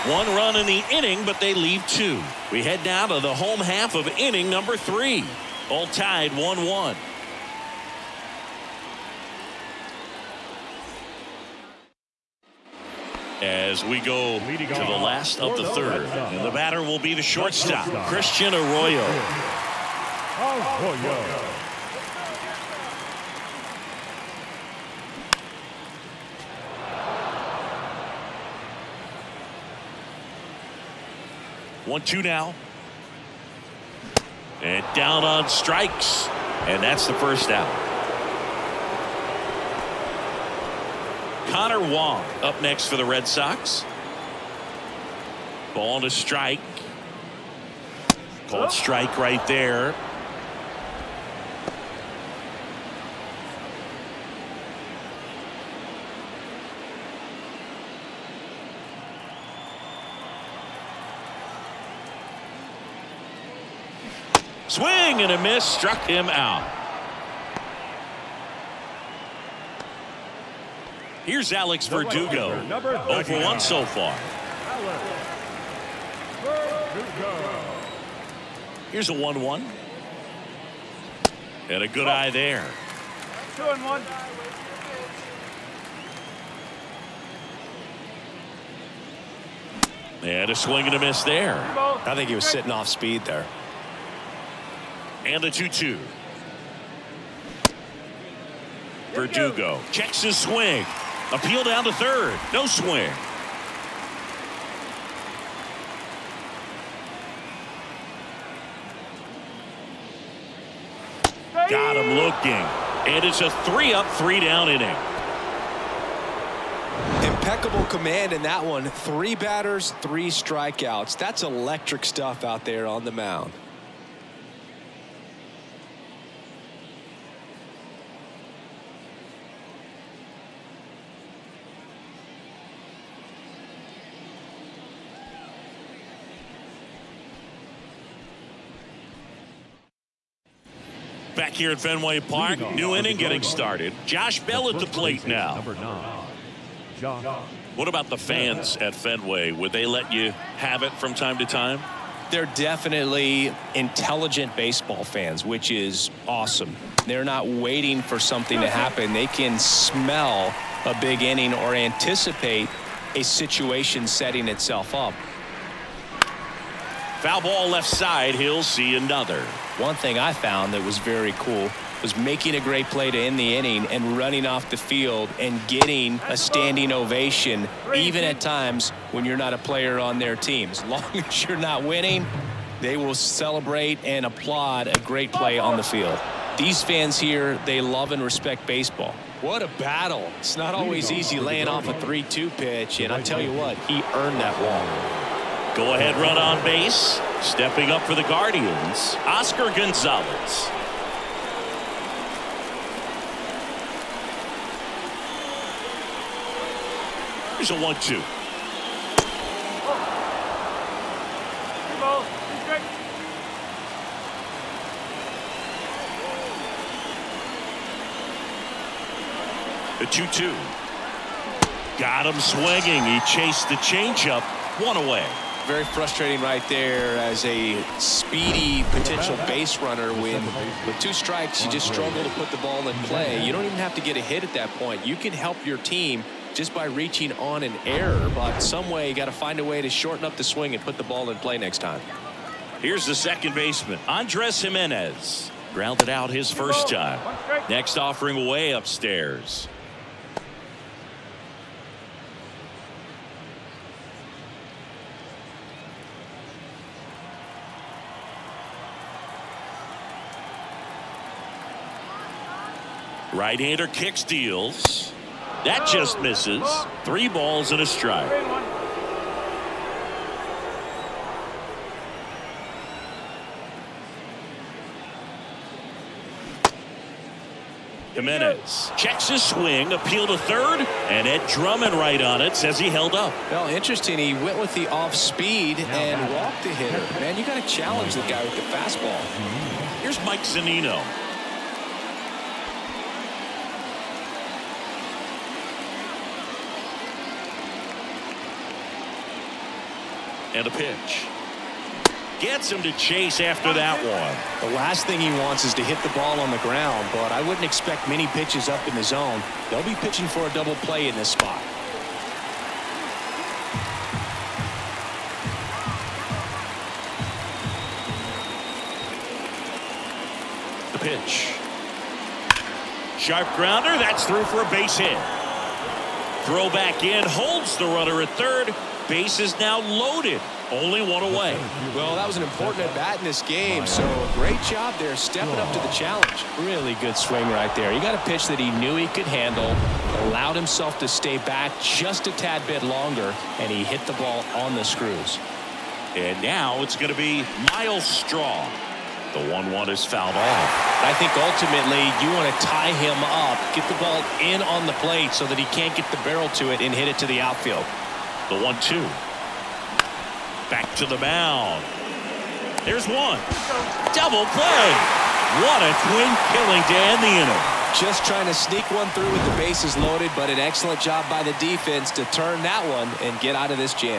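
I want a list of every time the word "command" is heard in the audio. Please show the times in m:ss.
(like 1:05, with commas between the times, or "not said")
1:57.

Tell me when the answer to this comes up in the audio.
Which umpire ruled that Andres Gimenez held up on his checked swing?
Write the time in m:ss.
4:41.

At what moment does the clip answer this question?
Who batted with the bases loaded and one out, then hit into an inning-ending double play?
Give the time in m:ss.
5:47.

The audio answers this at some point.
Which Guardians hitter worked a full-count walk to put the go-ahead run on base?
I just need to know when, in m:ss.
2:24.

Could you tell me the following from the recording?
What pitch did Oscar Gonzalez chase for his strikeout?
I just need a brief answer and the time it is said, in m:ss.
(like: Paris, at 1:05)
changeup, at 3:43.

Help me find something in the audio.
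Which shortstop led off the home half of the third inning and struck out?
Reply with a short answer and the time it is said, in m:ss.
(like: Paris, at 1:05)
Christian Arroyo, at 0:18.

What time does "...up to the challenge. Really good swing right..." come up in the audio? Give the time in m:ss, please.
5:35.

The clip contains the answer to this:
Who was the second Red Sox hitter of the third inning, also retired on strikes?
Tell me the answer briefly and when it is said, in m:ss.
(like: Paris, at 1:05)
Connor Wong, at 0:41.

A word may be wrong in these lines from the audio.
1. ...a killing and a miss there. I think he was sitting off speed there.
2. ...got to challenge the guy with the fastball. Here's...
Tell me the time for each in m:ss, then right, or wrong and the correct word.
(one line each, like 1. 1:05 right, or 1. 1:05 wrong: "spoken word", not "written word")
1. 1:30 wrong: "swing", not "killing"
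2. 4:47 right.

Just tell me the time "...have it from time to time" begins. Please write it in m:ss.
2:30.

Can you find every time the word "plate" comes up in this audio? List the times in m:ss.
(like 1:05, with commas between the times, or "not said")
2:24, 5:55.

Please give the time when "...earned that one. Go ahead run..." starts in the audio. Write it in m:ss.
3:14.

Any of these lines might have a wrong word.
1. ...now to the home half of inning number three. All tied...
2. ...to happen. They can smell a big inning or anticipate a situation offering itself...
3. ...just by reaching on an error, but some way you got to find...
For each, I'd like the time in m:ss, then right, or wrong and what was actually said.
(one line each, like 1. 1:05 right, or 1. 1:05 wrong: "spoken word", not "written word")
1. 0:02 right
2. 2:38 wrong: "setting", not "offering"
3. 3:56 right.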